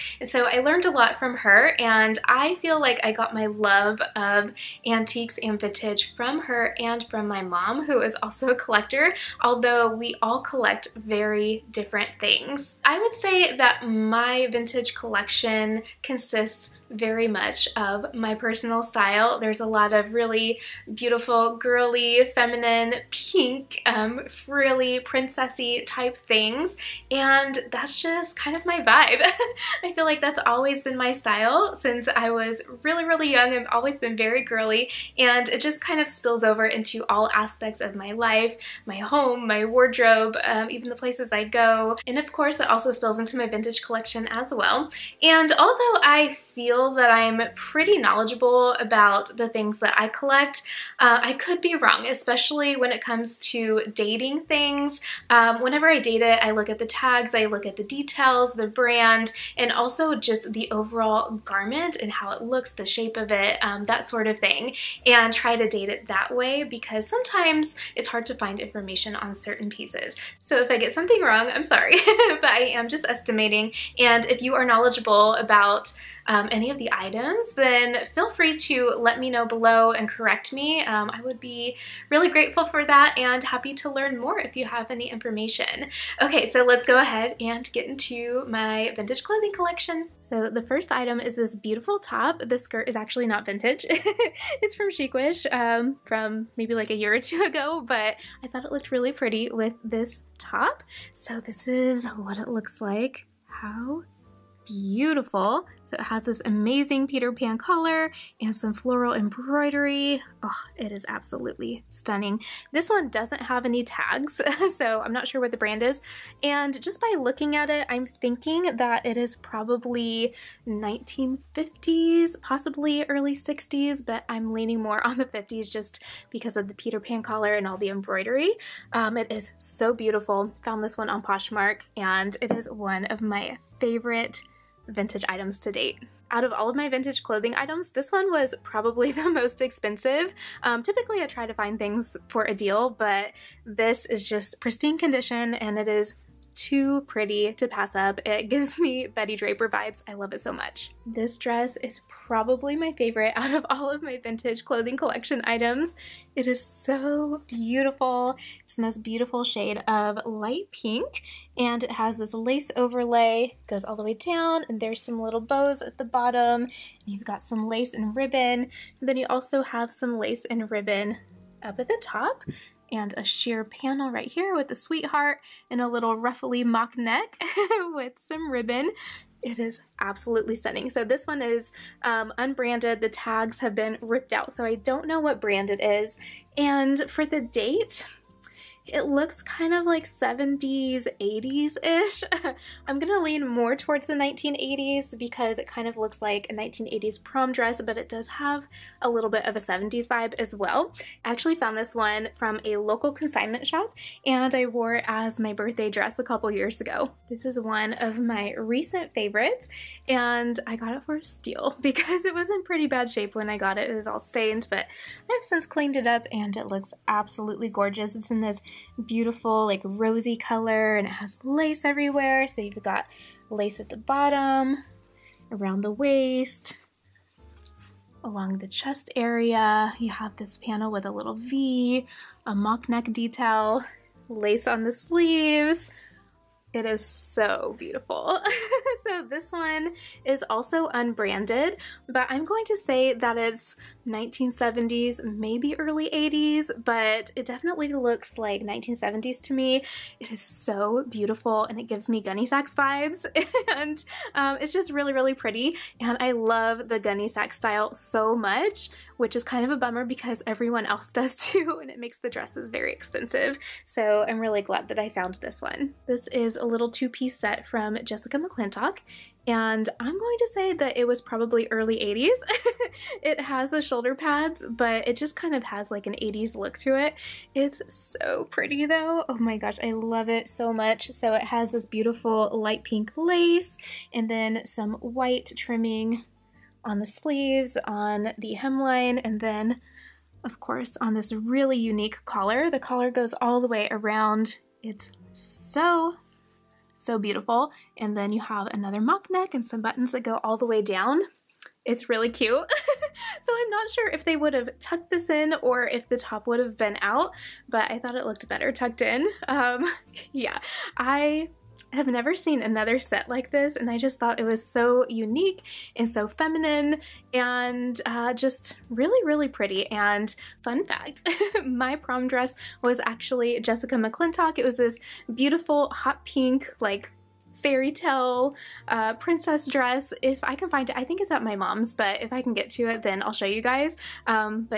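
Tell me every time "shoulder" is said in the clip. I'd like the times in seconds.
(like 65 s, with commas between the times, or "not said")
273 s.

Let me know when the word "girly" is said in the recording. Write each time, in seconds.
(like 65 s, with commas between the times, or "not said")
21 s, 34 s.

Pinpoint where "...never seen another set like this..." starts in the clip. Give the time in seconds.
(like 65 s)
312 s.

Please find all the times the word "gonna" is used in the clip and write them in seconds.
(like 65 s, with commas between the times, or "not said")
192 s.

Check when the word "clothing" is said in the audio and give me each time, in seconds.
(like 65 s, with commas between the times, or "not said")
89 s, 137 s, 154 s.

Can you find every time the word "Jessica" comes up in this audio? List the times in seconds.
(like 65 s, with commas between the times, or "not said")
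268 s, 323 s.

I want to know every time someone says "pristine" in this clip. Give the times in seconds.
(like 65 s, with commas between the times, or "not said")
144 s.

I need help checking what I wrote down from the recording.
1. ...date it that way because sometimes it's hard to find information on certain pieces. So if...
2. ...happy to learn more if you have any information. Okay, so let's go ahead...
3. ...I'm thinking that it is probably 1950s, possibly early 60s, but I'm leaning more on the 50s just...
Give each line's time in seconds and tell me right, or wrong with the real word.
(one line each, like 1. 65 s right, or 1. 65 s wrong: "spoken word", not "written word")
1. 65 s right
2. 83 s right
3. 117 s right.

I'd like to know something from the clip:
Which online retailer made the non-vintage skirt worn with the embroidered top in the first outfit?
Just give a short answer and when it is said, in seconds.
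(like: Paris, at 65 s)
Chicwish, at 94 s.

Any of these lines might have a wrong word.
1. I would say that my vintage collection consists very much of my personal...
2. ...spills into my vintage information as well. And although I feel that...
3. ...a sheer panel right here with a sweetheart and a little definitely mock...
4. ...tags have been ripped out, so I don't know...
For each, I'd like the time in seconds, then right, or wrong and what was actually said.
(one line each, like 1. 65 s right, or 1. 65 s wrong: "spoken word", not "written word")
1. 12 s right
2. 42 s wrong: "collection", not "information"
3. 173 s wrong: "ruffly", not "definitely"
4. 183 s right.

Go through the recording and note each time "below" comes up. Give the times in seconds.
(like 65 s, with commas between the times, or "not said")
79 s.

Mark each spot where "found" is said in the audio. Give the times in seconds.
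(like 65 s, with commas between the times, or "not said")
130 s, 201 s, 265 s.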